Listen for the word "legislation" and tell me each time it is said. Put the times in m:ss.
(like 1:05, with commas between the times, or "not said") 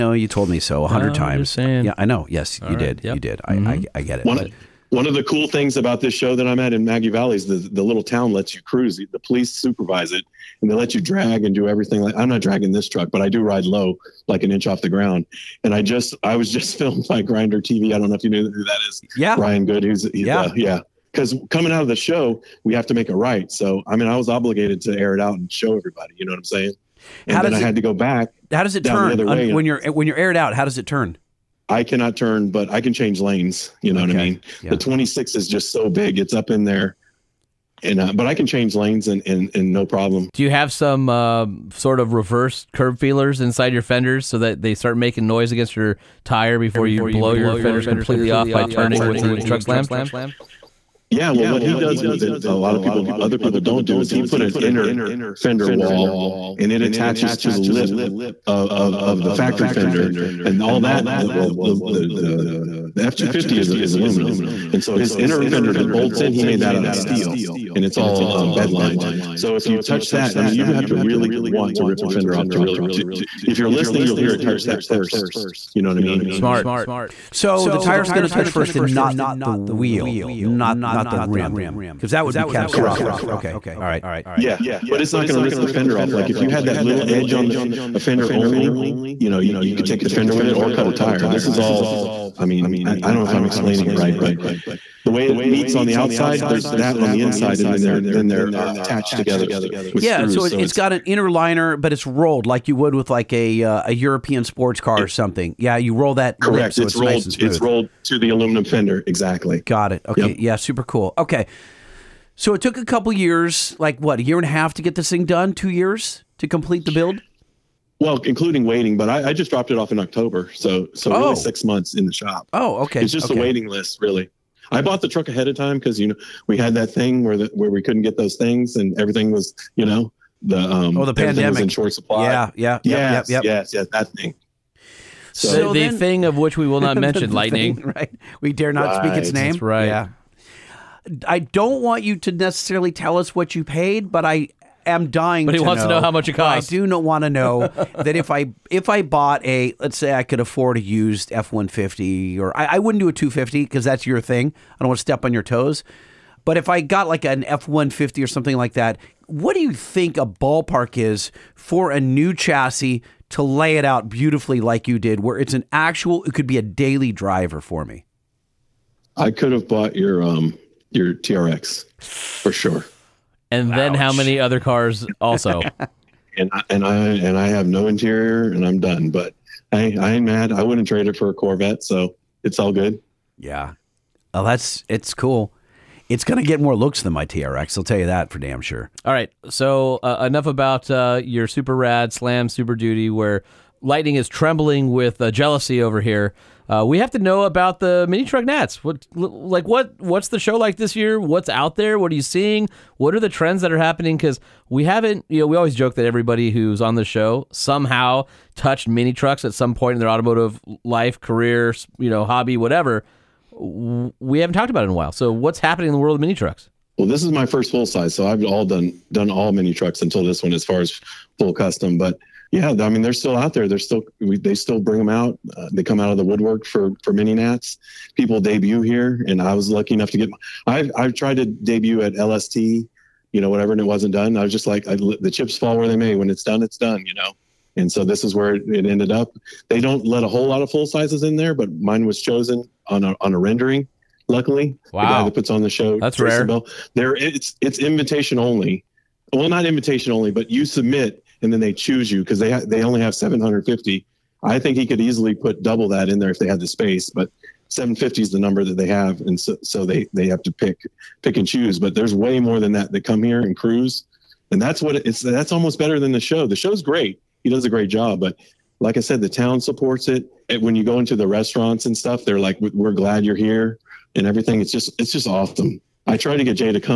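not said.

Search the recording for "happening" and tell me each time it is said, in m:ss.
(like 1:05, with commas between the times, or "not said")
3:23, 3:35.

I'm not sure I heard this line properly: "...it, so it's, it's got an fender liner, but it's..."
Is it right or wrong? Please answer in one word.
wrong.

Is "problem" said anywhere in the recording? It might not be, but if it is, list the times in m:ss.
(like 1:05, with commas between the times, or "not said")
0:39.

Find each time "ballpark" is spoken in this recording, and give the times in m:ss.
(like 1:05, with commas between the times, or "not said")
2:40.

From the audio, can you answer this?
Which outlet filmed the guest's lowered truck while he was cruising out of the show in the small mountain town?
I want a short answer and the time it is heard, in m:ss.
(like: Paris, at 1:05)
Grinder TV, at 0:17.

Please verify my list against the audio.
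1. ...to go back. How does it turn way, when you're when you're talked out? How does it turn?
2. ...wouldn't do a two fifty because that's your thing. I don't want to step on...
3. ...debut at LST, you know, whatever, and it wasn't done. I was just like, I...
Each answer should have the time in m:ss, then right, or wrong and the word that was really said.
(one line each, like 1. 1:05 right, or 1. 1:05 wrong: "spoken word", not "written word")
1. 0:27 wrong: "aired", not "talked"
2. 2:32 right
3. 3:51 right.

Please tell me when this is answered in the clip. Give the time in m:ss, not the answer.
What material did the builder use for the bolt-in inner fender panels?
1:06.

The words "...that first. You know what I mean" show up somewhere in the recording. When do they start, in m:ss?
1:14.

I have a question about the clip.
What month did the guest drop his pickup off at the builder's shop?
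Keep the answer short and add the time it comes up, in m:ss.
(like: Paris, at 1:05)
October, at 1:59.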